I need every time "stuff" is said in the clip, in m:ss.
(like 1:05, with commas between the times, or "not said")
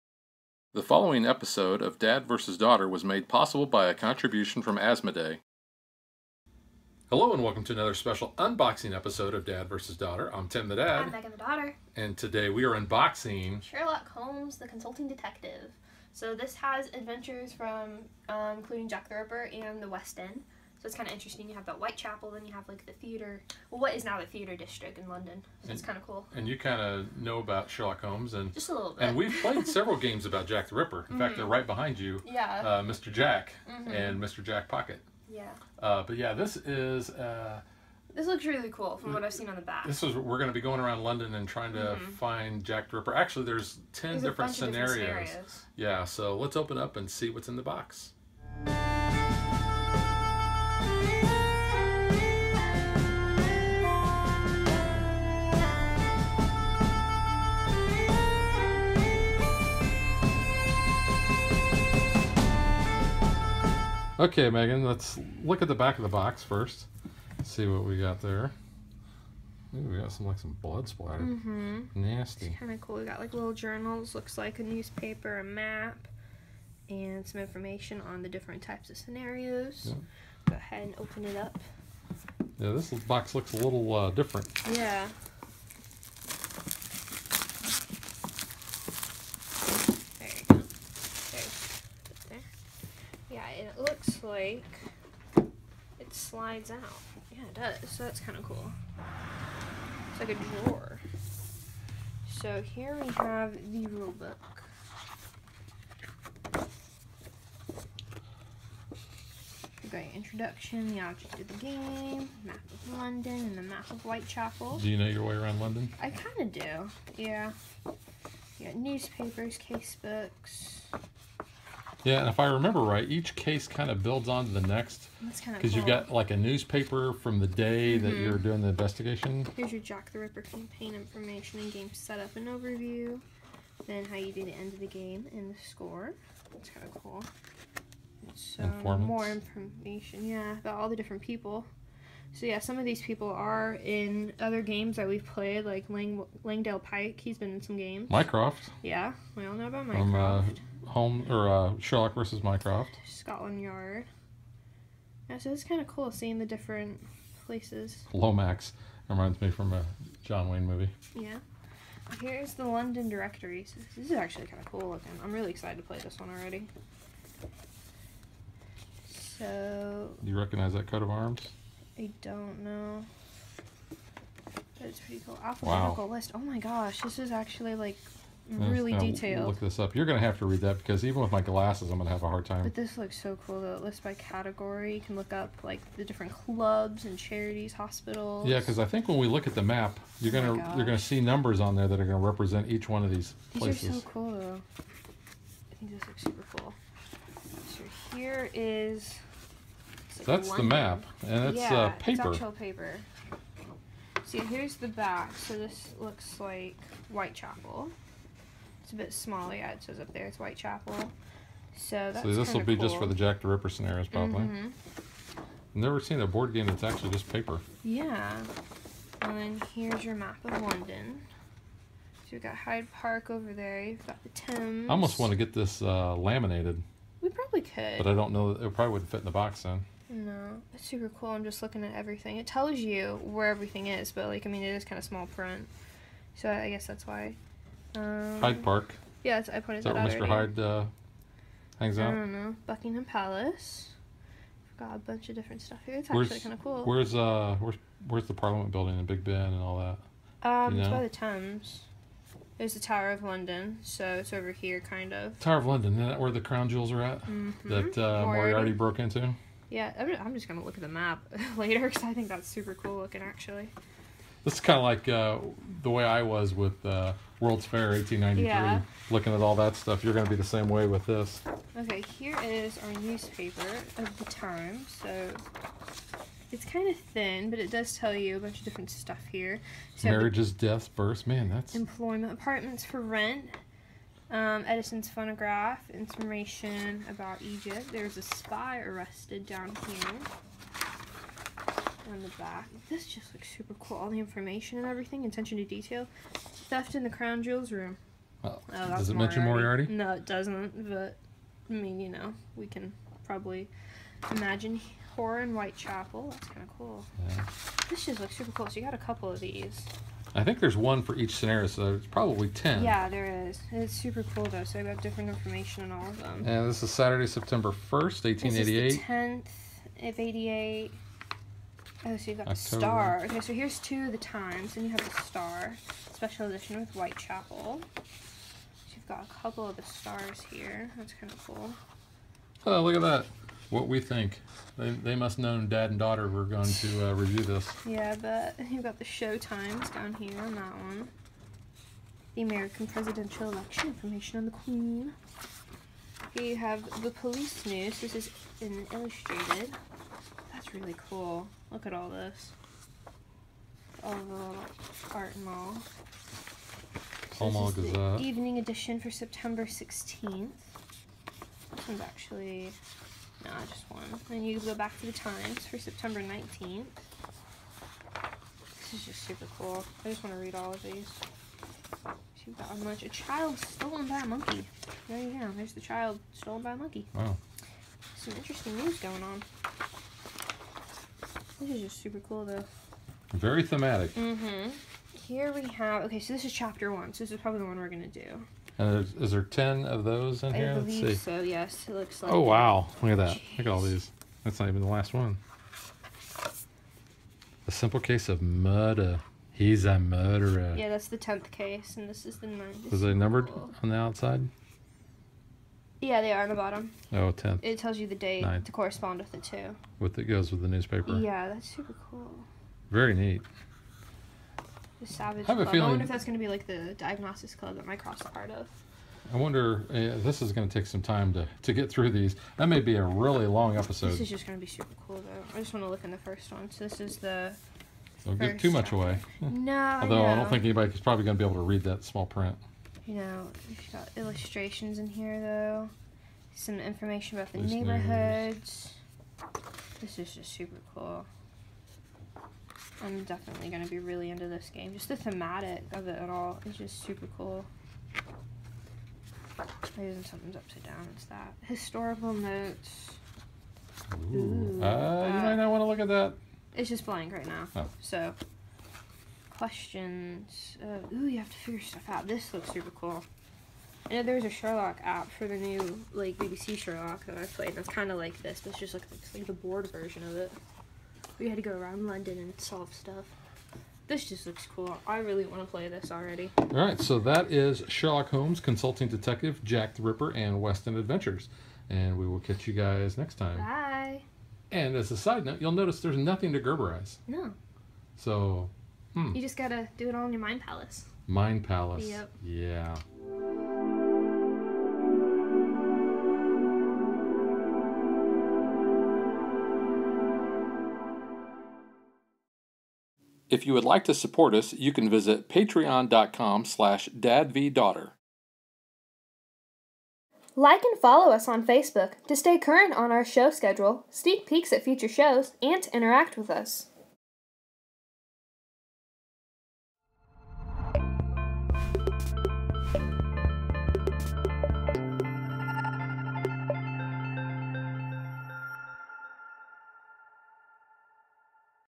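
4:05, 4:29, 4:38, 7:41, 7:52.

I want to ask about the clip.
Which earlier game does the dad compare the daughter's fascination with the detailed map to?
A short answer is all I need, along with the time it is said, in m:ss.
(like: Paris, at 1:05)
World's Fair 1893, at 4:27.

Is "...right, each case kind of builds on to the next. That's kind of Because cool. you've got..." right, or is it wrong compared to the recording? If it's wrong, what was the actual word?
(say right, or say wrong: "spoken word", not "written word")
right.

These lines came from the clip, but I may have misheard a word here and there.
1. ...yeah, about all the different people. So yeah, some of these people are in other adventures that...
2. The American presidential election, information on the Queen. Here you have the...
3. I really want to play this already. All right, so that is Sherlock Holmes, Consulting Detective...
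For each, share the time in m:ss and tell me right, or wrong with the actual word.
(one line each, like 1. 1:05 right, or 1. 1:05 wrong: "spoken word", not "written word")
1. 2:20 wrong: "games", not "adventures"
2. 5:42 right
3. 7:55 right.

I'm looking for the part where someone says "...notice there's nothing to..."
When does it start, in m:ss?
8:05.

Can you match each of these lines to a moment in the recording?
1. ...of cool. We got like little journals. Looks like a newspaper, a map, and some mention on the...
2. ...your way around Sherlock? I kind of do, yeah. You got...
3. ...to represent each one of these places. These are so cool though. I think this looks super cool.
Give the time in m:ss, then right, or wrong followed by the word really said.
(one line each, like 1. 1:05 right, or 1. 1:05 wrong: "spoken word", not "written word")
1. 1:12 wrong: "information", not "mention"
2. 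1:55 wrong: "London", not "Sherlock"
3. 3:12 right.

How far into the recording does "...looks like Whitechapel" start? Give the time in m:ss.
3:25.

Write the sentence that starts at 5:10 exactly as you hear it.
I think there's one for each scenario, so it's probably 10.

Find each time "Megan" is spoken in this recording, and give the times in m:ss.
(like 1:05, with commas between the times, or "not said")
0:11, 1:04.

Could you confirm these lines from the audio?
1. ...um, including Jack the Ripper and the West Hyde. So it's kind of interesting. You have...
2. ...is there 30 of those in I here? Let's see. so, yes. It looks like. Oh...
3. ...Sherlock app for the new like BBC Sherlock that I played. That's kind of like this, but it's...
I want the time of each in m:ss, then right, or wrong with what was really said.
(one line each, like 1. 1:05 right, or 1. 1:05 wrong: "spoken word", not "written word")
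1. 0:18 wrong: "End", not "Hyde"
2. 6:29 wrong: "10", not "30"
3. 7:44 right.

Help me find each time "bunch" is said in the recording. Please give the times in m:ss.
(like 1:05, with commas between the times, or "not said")
4:04, 4:38.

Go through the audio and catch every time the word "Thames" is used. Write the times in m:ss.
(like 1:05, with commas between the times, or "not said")
3:44, 4:11.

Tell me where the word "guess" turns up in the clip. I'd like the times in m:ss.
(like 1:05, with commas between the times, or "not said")
3:56.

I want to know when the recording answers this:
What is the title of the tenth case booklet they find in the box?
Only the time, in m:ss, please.
6:37.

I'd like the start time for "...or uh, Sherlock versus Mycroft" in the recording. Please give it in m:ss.
2:31.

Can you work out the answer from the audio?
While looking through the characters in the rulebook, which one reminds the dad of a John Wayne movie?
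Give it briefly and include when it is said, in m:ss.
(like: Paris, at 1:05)
Lomax, at 2:38.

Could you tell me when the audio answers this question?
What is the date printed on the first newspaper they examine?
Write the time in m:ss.
5:16.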